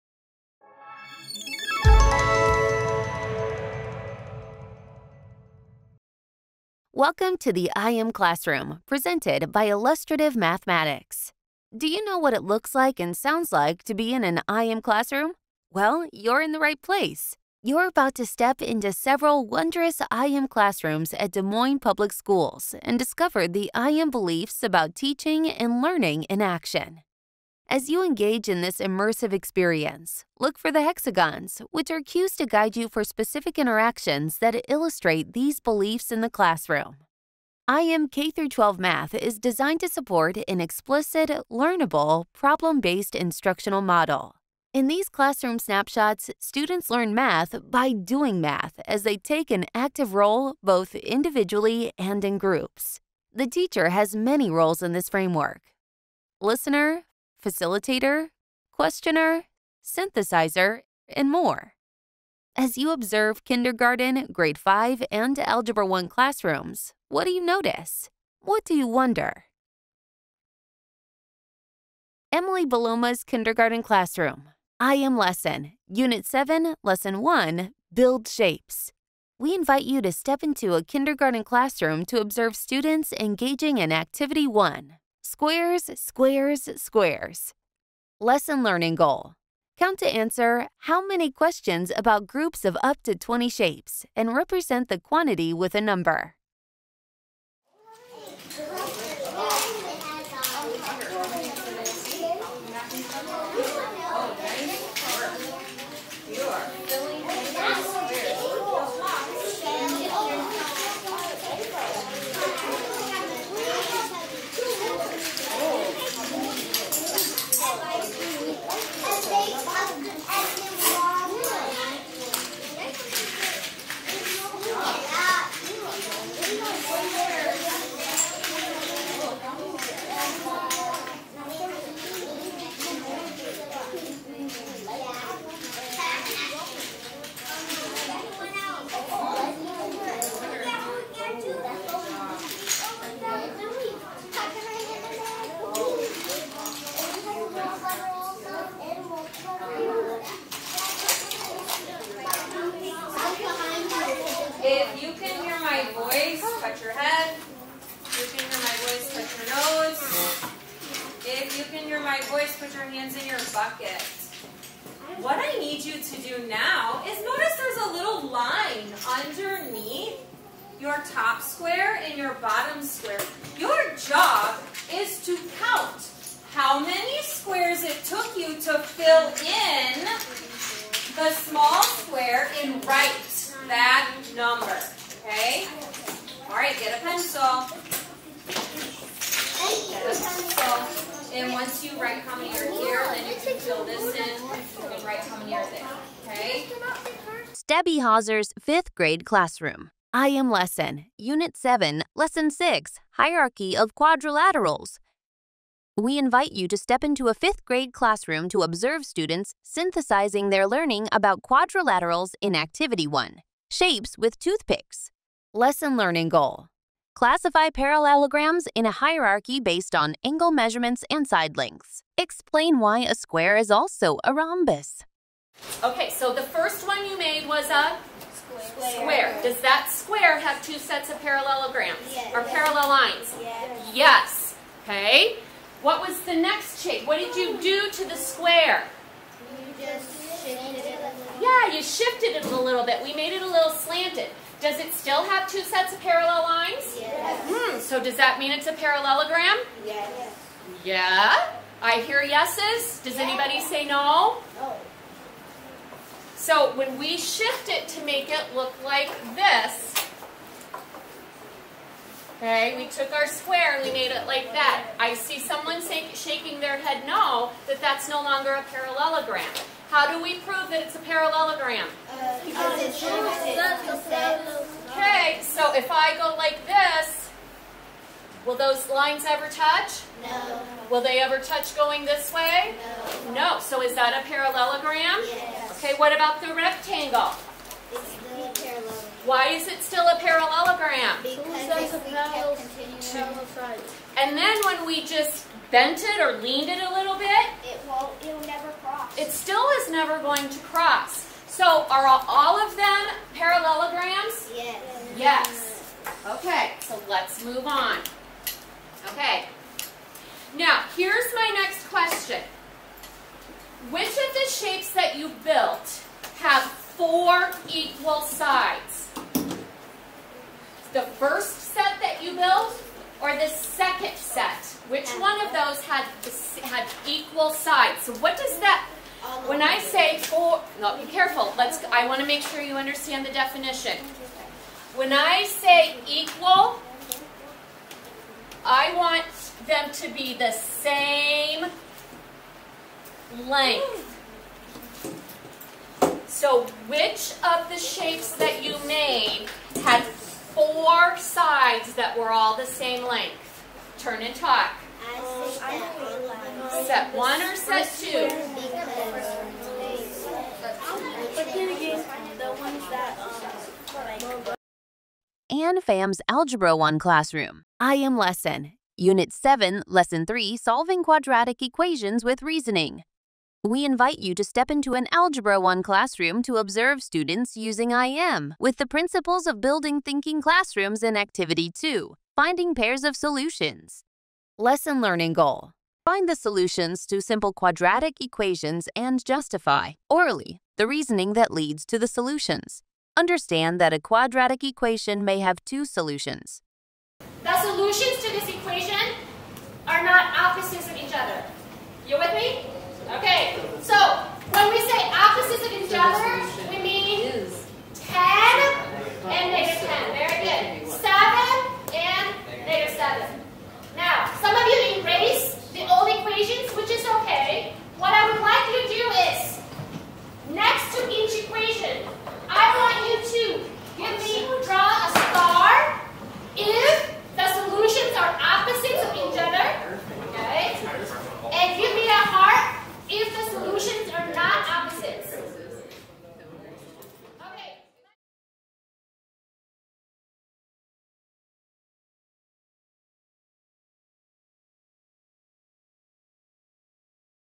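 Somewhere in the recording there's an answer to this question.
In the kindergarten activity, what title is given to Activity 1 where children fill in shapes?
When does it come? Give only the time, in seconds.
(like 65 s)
85 s.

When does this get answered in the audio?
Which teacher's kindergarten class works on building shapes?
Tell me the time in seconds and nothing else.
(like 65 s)
72 s.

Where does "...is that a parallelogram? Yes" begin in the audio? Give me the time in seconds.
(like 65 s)
283 s.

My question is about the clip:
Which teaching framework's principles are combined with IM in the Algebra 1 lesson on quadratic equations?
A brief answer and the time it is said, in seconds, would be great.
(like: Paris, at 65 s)
Building thinking classrooms, at 379 s.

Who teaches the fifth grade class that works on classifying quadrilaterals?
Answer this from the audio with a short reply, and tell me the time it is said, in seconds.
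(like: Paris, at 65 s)
Debbie Hauser, at 197 s.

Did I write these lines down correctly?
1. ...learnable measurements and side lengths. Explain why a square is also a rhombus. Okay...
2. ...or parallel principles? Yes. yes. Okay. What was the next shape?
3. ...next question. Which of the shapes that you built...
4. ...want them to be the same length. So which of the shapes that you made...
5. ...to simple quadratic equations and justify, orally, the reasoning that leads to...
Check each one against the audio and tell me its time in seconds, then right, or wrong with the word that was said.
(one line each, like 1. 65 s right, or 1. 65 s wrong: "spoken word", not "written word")
1. 220 s wrong: "angle", not "learnable"
2. 232 s wrong: "lines", not "principles"
3. 311 s right
4. 338 s right
5. 387 s right.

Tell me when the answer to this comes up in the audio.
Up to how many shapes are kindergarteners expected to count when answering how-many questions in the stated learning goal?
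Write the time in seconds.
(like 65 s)
92 s.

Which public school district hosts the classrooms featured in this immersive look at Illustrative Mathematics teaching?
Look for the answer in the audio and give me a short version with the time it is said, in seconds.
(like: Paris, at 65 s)
Des Moines Public Schools, at 21 s.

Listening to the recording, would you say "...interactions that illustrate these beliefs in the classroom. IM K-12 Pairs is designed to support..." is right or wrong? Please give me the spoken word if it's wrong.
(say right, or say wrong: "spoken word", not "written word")
wrong: "Math", not "Pairs".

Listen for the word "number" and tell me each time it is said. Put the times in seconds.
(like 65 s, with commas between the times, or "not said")
95 s, 184 s.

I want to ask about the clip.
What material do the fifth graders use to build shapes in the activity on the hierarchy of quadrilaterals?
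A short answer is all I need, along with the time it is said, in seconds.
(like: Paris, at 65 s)
Toothpicks, at 214 s.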